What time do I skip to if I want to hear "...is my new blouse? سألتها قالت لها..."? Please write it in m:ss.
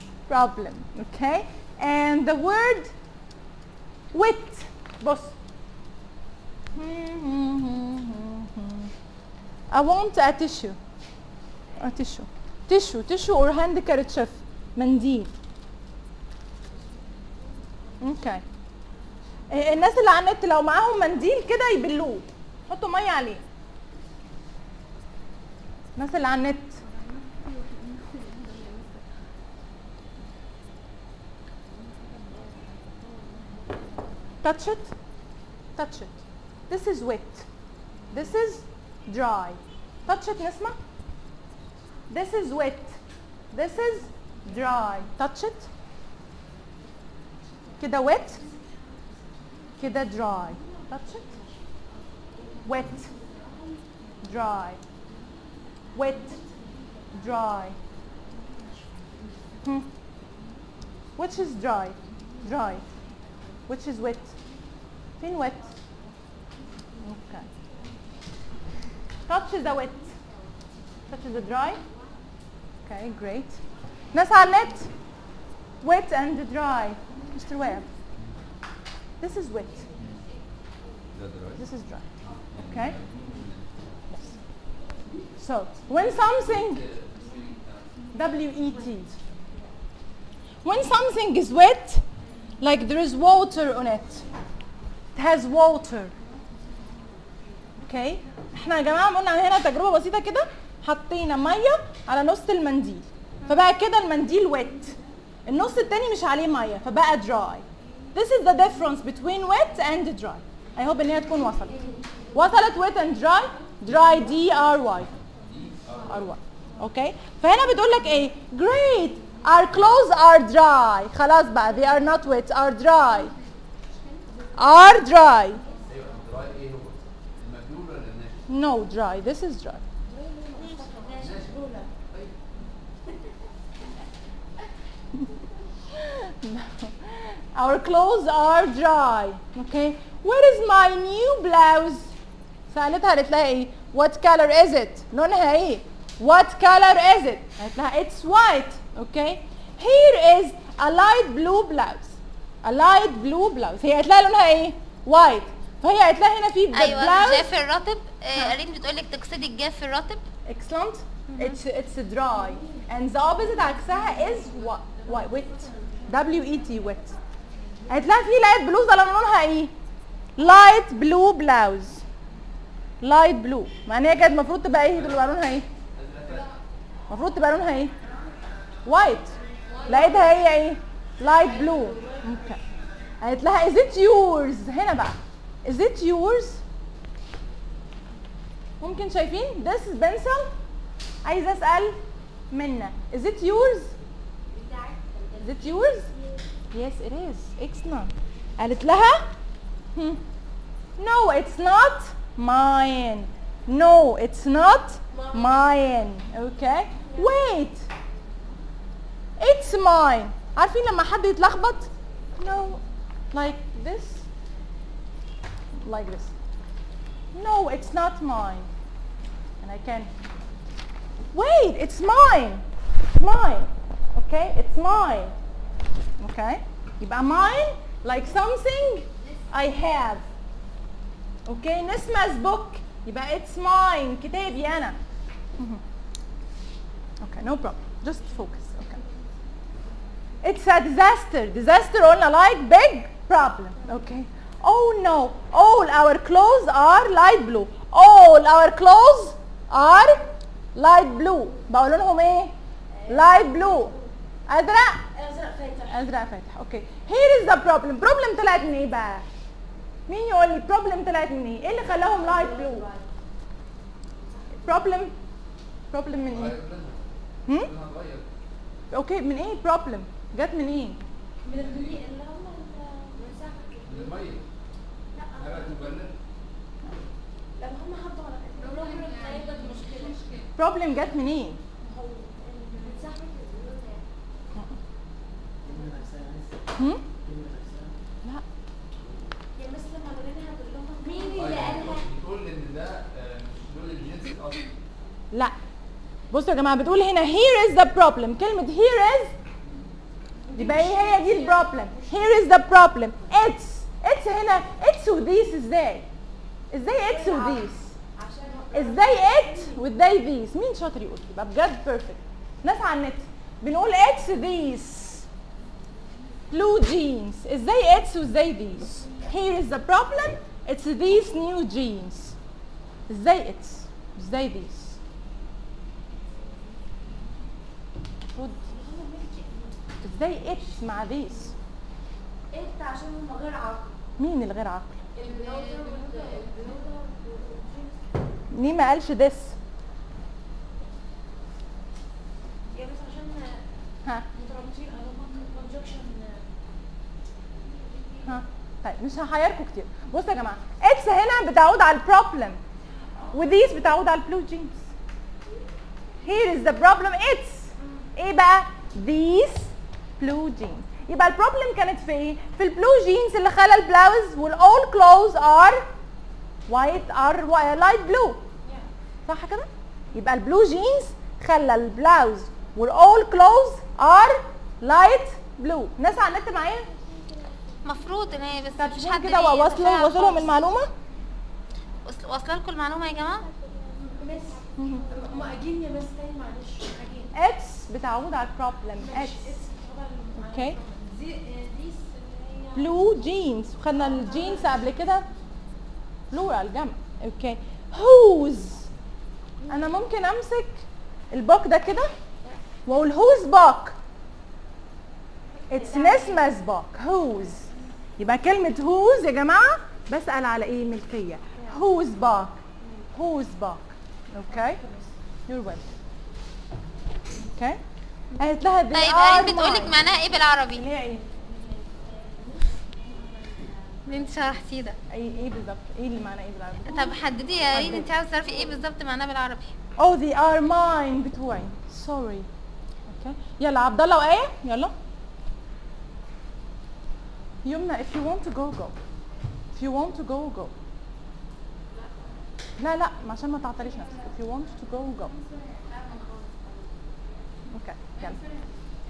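2:20.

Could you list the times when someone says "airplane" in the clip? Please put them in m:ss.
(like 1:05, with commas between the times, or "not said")
not said.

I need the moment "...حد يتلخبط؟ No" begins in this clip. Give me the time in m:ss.
3:31.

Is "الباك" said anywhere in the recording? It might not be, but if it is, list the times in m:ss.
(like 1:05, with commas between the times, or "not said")
6:41.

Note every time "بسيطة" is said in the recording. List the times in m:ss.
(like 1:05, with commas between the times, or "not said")
1:39.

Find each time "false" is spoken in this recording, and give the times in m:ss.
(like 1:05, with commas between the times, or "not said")
not said.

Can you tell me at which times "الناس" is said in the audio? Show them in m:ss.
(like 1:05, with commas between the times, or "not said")
0:19, 0:25, 6:15.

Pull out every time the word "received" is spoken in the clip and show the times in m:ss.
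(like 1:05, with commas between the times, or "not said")
not said.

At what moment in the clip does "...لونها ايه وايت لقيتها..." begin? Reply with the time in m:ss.
2:57.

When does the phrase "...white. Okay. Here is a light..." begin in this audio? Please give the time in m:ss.
2:28.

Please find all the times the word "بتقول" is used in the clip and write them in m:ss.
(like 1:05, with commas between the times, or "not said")
1:57, 2:38, 4:56, 6:59.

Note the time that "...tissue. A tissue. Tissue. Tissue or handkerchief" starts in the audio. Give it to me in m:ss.
0:10.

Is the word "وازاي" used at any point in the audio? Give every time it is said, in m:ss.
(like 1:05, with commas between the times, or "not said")
5:09, 5:18.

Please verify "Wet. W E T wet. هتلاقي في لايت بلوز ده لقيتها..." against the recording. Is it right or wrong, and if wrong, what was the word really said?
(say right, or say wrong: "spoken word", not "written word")
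wrong: "لونها", not "لقيتها".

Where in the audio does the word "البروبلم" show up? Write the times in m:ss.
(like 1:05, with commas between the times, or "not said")
5:01, 5:51, 6:01, 6:28.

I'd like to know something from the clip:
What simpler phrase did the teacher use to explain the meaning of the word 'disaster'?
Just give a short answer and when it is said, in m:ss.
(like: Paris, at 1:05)
Big problem, at 4:02.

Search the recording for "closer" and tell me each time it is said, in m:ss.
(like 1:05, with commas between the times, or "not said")
not said.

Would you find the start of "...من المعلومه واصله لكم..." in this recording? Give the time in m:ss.
6:20.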